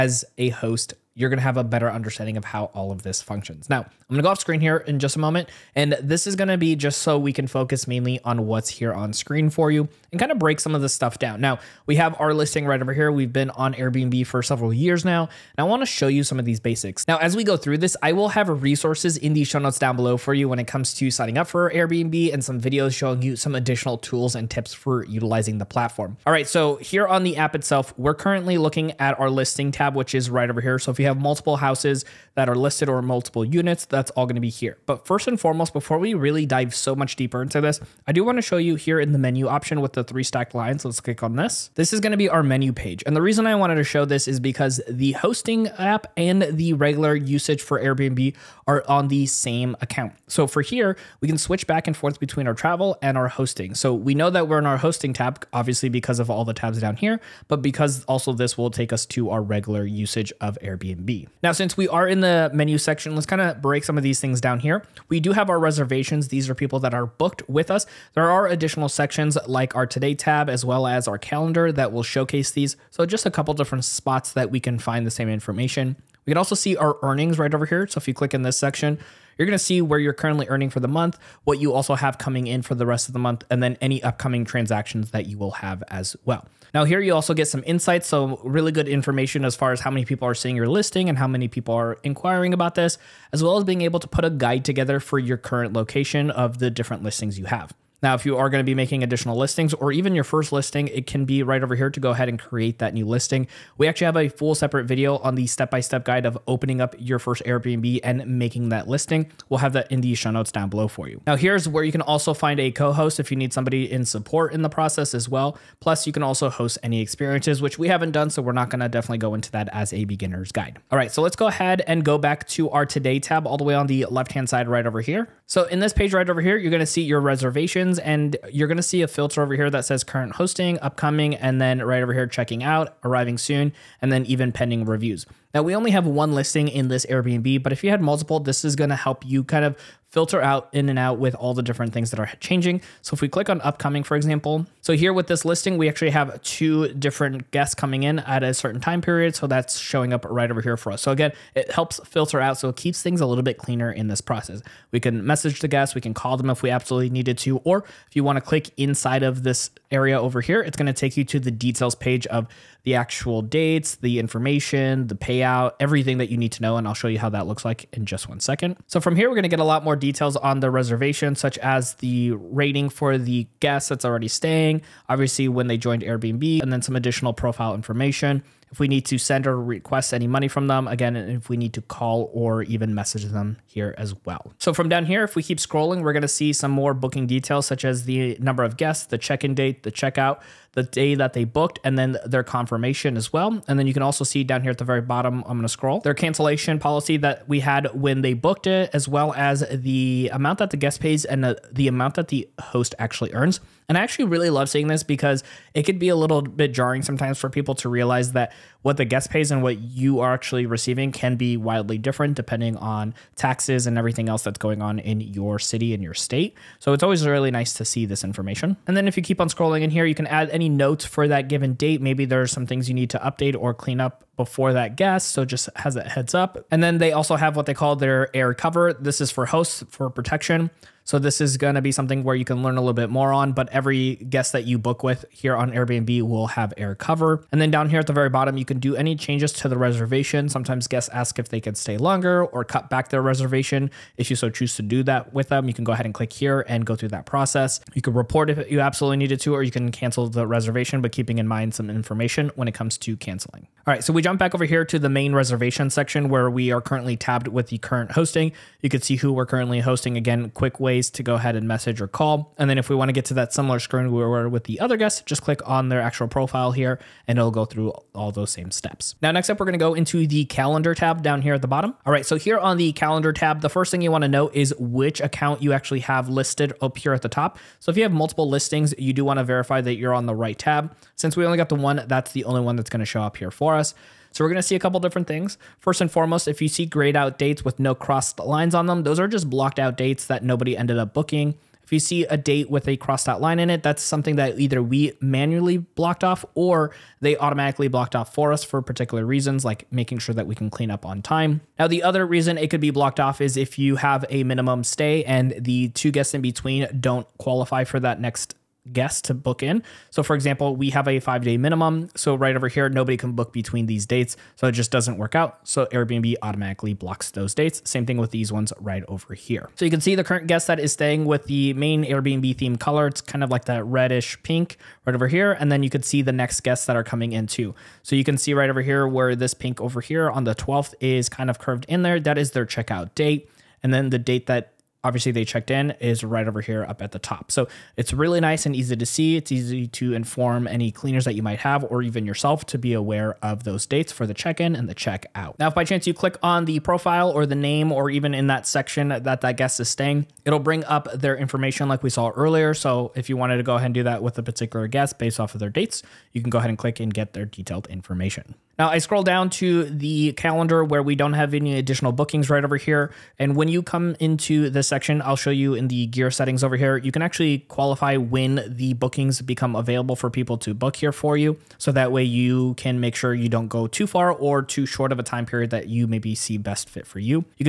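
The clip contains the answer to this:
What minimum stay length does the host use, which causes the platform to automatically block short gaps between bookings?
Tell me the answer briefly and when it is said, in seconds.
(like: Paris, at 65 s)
5 days, at 311 s.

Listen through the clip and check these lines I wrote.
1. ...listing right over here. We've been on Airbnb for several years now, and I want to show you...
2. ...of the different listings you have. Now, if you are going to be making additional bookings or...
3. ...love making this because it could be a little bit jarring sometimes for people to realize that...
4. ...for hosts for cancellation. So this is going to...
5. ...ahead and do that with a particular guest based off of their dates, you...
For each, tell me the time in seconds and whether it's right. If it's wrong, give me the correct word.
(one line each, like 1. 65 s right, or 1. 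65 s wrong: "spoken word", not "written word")
1. 12 s right
2. 96 s wrong: "listings", not "bookings"
3. 204 s wrong: "seeing", not "making"
4. 229 s wrong: "protection", not "cancellation"
5. 353 s right.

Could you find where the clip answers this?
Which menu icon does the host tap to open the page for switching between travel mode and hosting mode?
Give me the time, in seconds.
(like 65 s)
40 s.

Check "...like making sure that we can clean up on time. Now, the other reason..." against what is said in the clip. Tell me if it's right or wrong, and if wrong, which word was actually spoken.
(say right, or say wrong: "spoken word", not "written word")
right.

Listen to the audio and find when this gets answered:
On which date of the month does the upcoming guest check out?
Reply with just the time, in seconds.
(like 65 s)
330 s.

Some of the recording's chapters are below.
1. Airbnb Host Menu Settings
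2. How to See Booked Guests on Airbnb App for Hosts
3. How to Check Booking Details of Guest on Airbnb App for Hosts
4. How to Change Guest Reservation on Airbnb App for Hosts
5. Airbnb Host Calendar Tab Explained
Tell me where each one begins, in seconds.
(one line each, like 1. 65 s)
1. 40 s
2. 120 s
3. 182 s
4. 238 s
5. 267 s.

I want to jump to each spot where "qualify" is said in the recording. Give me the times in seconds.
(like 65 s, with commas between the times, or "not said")
307 s, 367 s.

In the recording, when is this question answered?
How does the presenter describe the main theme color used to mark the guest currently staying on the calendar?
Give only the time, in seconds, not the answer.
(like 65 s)
323 s.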